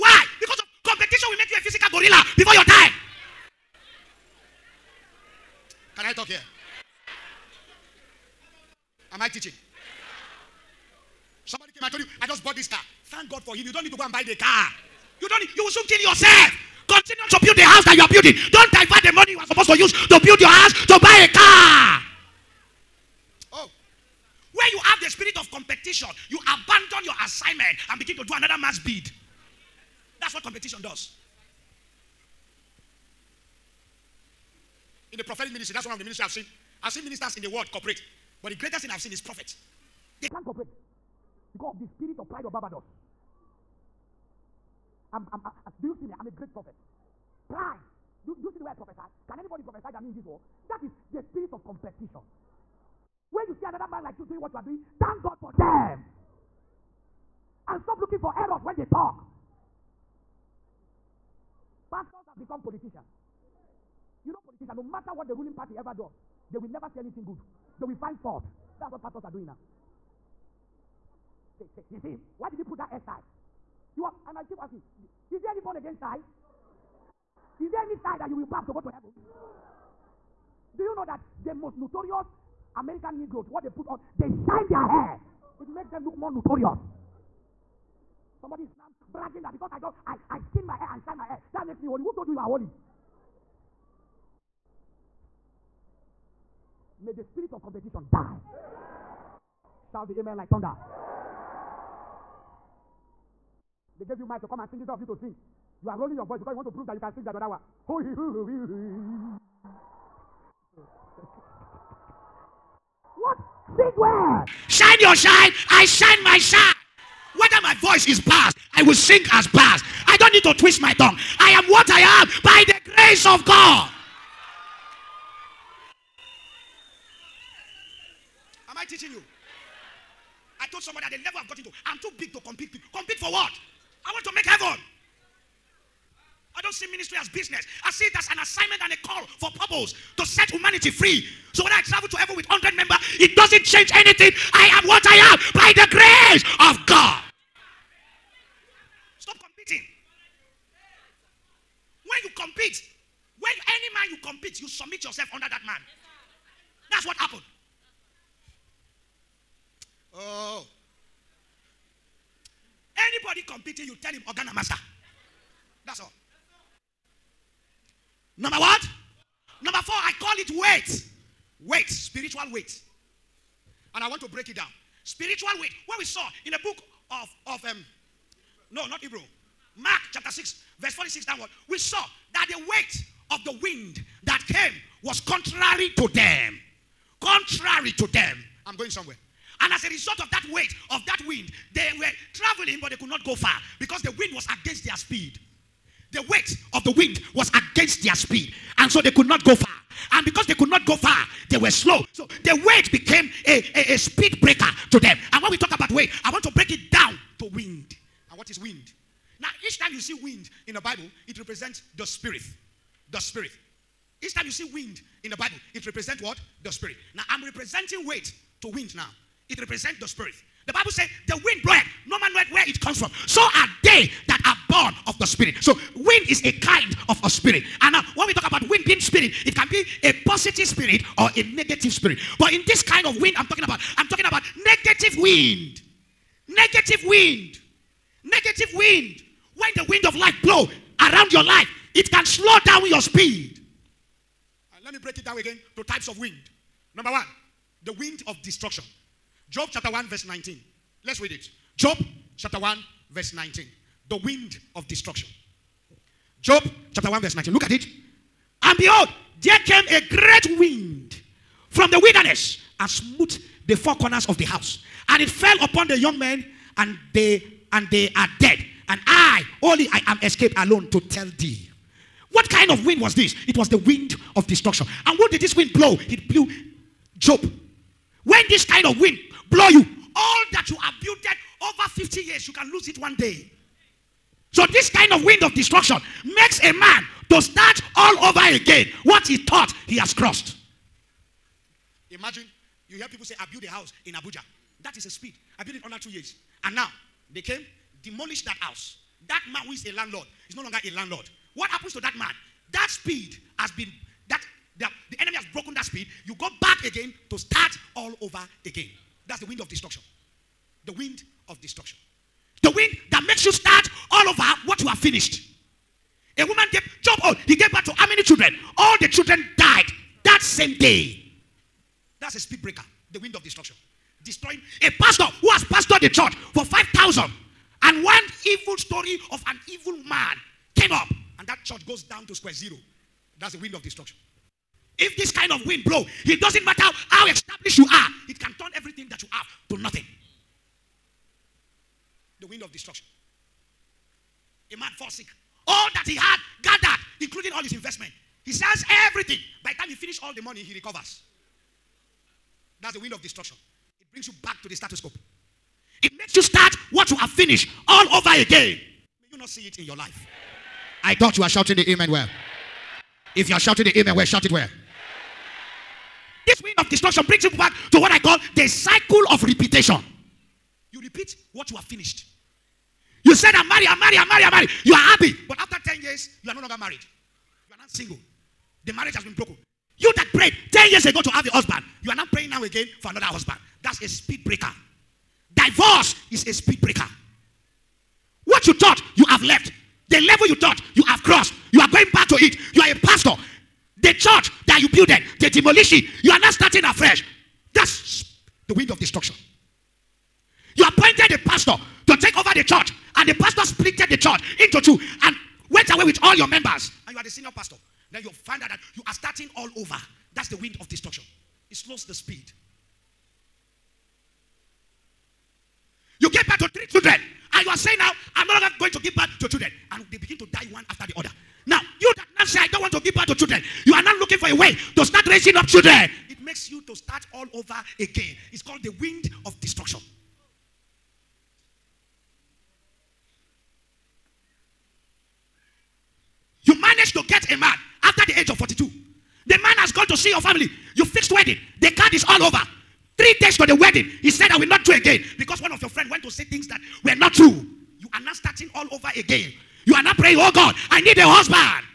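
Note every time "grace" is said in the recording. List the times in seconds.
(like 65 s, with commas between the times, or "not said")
122 s, 145 s.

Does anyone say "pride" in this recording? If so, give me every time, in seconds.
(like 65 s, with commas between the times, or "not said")
42 s, 47 s.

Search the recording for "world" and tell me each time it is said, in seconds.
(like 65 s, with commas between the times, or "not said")
37 s, 50 s.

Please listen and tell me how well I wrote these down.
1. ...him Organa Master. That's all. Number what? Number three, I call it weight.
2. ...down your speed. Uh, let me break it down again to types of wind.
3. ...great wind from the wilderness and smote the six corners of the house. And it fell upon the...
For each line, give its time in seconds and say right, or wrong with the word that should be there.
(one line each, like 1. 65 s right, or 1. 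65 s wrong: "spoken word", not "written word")
1. 164 s wrong: "four", not "three"
2. 242 s right
3. 260 s wrong: "four", not "six".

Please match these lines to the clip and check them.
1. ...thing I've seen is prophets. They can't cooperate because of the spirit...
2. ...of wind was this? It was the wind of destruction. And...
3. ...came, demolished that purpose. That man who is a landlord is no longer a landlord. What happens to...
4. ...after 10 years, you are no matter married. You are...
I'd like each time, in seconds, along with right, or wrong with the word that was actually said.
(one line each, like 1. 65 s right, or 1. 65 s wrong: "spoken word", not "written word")
1. 38 s right
2. 272 s right
3. 297 s wrong: "house", not "purpose"
4. 375 s wrong: "longer", not "matter".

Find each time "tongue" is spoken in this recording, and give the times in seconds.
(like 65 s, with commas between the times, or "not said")
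120 s.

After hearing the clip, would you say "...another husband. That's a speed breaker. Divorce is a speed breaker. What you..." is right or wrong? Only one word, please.
right.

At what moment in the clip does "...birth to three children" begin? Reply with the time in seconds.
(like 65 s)
416 s.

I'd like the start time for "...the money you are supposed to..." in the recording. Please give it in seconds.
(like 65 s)
19 s.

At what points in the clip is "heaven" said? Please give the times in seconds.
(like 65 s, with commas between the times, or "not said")
78 s, 134 s, 142 s.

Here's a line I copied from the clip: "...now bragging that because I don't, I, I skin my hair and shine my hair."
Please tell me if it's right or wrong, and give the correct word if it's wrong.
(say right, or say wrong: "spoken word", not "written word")
right.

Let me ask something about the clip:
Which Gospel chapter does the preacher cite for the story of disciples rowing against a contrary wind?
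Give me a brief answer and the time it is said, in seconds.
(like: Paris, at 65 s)
Mark chapter 6, at 179 s.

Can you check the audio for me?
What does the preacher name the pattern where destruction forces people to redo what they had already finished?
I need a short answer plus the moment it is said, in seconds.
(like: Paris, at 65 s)
cycle of repetition, at 368 s.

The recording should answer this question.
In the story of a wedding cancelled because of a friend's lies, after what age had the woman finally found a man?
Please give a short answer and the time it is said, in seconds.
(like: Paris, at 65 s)
42, at 438 s.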